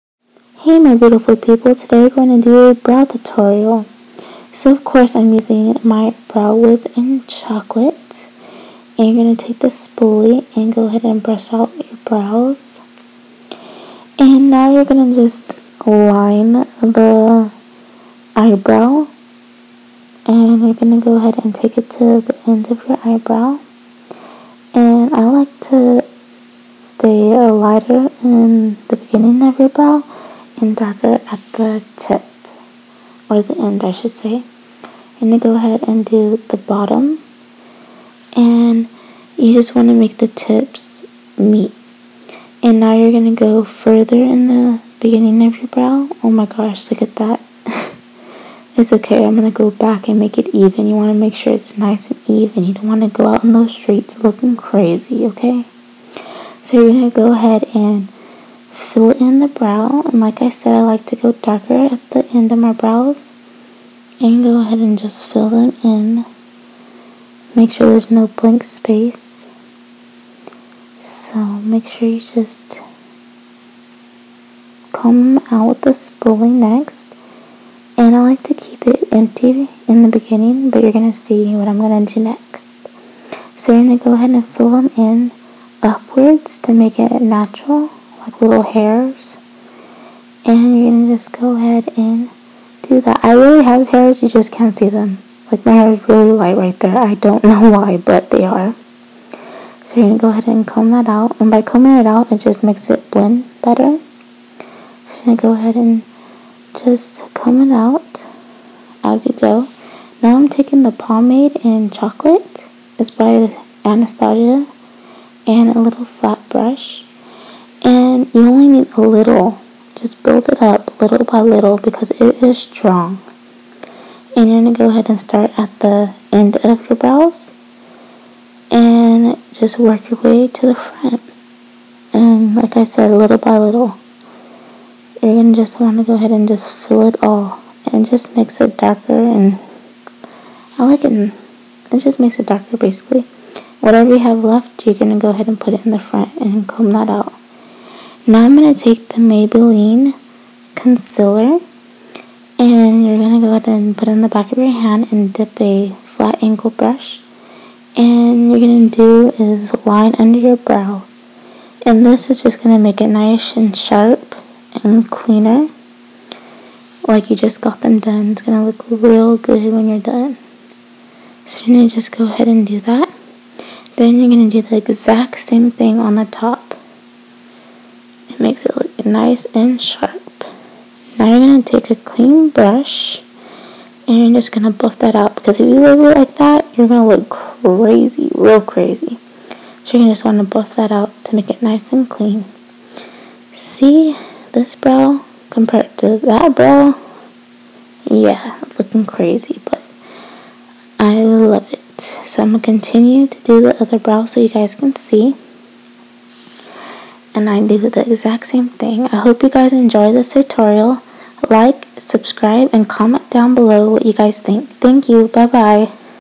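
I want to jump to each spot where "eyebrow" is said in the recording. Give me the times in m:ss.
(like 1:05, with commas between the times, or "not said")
0:18, 0:23.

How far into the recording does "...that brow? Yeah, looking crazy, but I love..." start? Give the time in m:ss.
3:16.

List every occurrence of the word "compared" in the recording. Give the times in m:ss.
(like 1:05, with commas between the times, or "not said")
3:15.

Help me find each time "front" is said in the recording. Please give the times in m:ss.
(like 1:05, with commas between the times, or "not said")
2:10, 2:25.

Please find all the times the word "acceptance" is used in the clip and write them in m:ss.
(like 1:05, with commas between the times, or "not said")
not said.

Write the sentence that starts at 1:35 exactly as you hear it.
Like my hair is really light right there.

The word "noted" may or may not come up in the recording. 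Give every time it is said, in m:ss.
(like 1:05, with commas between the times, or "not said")
not said.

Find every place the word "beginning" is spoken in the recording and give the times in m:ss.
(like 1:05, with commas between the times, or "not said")
0:28, 0:44, 1:20.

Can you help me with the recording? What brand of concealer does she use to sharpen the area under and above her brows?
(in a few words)
Maybelline.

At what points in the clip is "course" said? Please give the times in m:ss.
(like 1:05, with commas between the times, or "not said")
0:04.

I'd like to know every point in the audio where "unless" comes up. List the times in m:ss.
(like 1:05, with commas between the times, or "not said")
not said.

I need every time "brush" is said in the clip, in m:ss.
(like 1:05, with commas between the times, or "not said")
0:11, 1:56, 2:36, 3:02.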